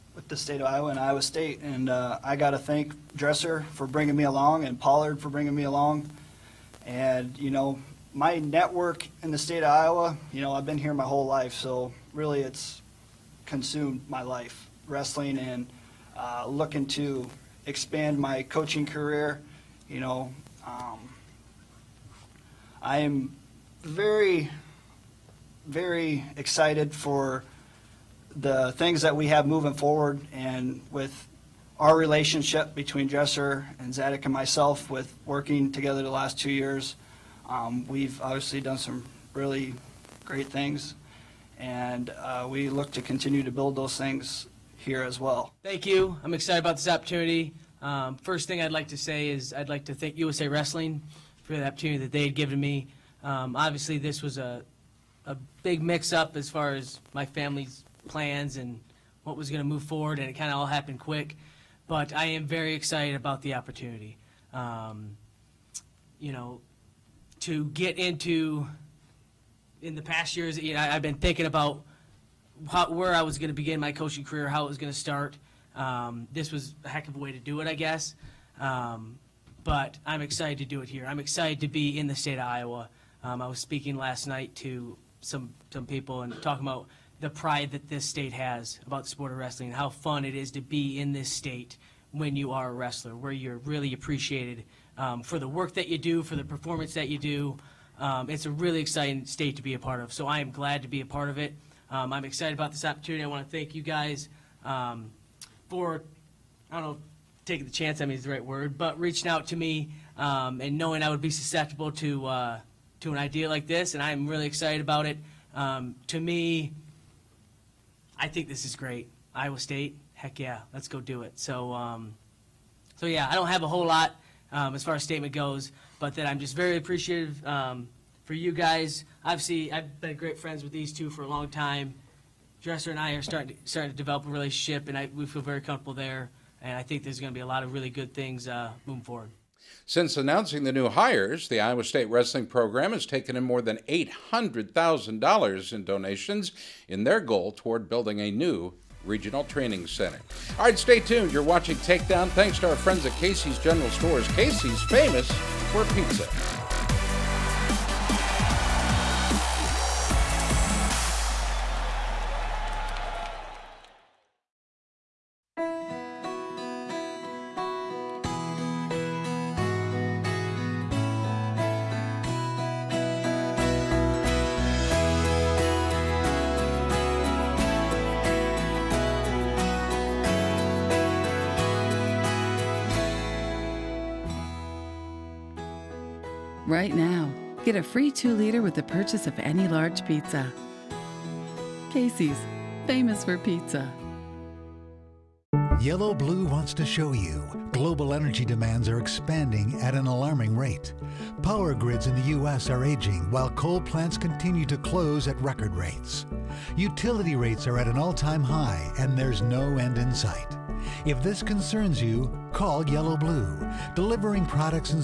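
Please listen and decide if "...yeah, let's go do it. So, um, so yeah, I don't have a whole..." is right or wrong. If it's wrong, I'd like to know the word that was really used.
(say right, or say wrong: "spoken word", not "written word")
right.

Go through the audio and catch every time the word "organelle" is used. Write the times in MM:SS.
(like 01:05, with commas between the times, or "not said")
not said.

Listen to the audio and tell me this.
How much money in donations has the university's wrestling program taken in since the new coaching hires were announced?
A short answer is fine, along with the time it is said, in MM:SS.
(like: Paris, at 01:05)
$800,000, at 02:23.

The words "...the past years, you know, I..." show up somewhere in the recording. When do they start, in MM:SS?
01:09.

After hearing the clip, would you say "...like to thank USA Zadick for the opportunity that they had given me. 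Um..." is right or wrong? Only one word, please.
wrong.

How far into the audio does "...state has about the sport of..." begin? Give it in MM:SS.
01:28.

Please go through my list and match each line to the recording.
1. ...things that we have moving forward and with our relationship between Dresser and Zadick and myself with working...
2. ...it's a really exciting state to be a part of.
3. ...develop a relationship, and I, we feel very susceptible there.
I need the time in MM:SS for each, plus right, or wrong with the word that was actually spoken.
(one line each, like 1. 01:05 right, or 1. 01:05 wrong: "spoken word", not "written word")
1. 00:28 right
2. 01:38 right
3. 02:13 wrong: "comfortable", not "susceptible".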